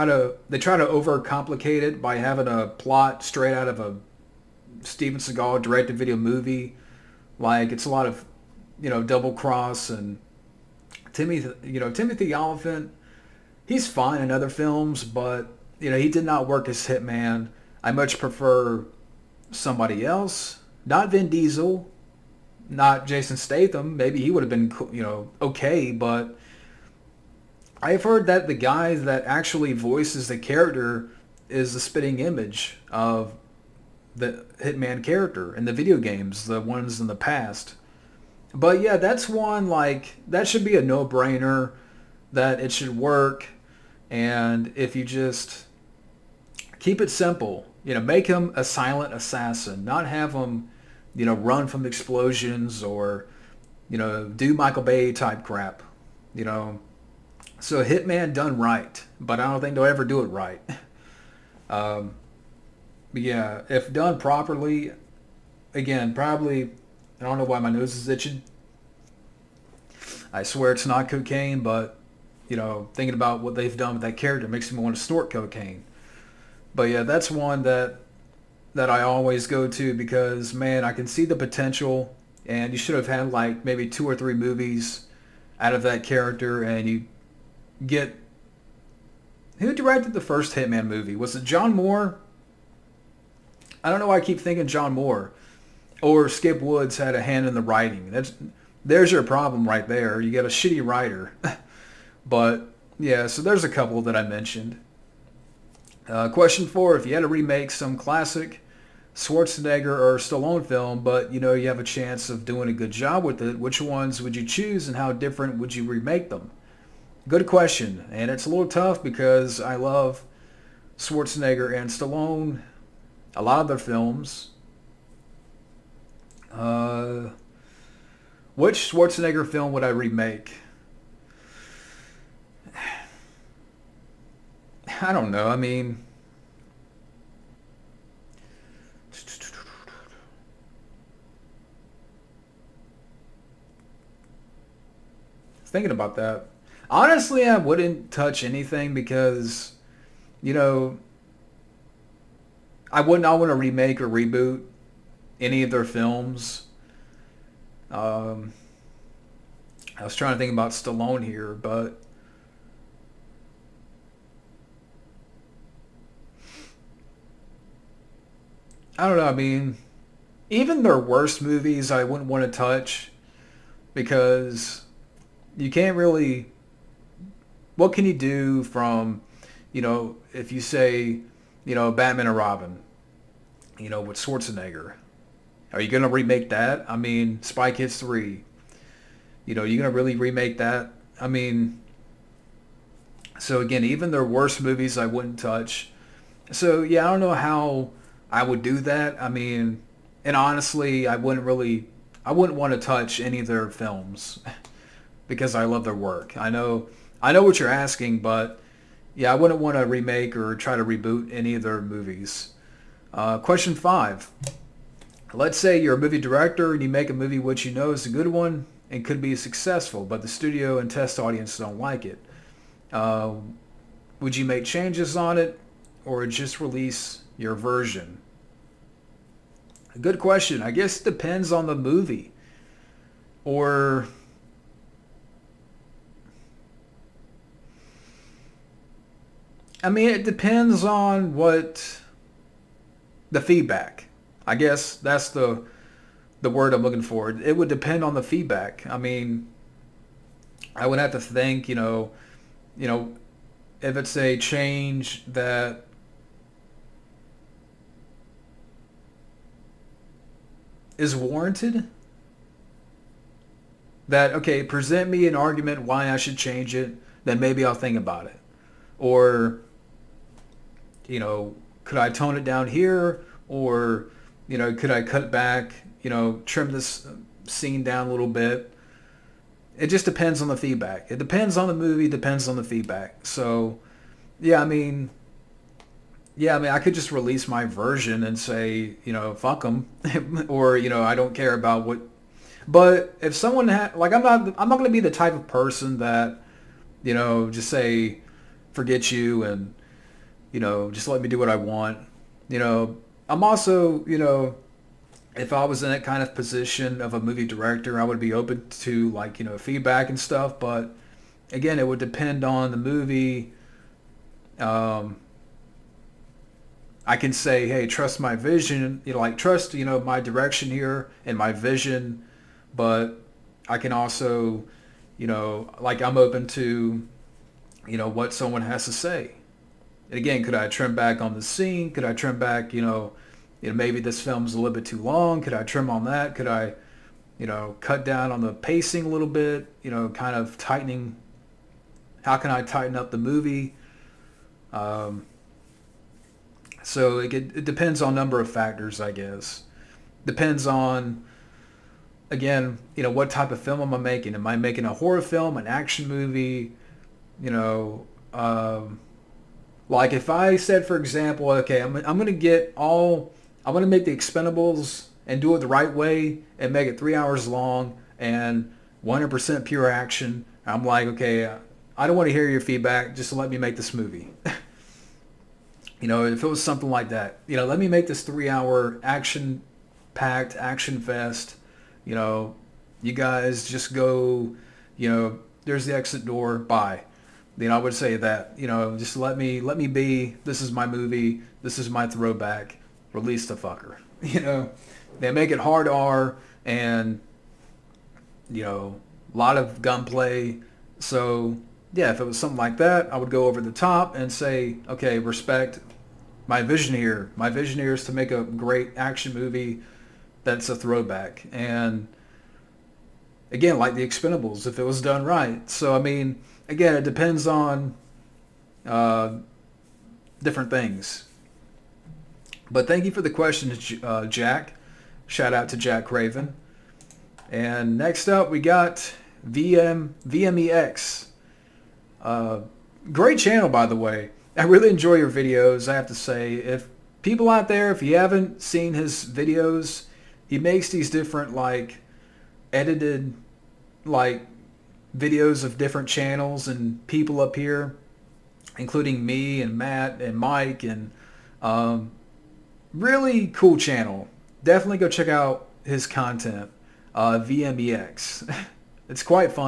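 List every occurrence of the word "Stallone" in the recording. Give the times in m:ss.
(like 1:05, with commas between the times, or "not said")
1:50, 2:01, 2:40.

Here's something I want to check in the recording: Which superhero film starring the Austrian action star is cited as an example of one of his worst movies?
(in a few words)
Batman and Robin.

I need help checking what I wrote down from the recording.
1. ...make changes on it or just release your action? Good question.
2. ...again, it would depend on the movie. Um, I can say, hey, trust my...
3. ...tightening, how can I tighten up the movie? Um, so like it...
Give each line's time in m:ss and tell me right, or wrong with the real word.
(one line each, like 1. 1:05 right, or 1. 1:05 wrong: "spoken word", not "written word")
1. 3:44 wrong: "version", not "action"
2. 5:11 right
3. 5:40 right.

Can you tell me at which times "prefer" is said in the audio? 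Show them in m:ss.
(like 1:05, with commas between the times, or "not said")
0:18.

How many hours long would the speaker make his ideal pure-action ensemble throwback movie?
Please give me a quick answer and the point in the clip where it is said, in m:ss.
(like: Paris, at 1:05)
3 hours, at 6:06.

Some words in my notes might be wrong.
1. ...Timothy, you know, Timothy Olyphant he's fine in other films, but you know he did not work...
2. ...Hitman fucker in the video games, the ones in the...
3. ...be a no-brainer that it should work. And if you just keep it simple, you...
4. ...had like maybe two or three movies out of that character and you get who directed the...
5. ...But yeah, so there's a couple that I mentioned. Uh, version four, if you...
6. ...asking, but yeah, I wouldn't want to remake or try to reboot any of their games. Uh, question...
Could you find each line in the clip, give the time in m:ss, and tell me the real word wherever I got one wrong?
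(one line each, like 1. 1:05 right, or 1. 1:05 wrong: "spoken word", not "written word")
1. 0:11 right
2. 0:34 wrong: "character", not "fucker"
3. 0:40 right
4. 1:23 right
5. 1:42 wrong: "question", not "version"
6. 3:27 wrong: "movies", not "games".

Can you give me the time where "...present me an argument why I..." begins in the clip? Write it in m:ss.
4:24.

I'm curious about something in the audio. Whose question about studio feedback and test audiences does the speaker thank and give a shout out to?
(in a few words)
Jack Craven.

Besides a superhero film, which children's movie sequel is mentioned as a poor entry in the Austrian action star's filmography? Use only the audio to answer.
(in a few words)
Spy Kids 3.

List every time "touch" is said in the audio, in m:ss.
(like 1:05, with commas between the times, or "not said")
2:28, 2:52, 3:15, 3:22.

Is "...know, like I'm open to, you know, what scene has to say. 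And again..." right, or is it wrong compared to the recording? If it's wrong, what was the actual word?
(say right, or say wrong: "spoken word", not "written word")
wrong: "someone", not "scene".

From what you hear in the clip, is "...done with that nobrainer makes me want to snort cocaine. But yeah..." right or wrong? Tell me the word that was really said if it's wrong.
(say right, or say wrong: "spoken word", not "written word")
wrong: "character", not "nobrainer".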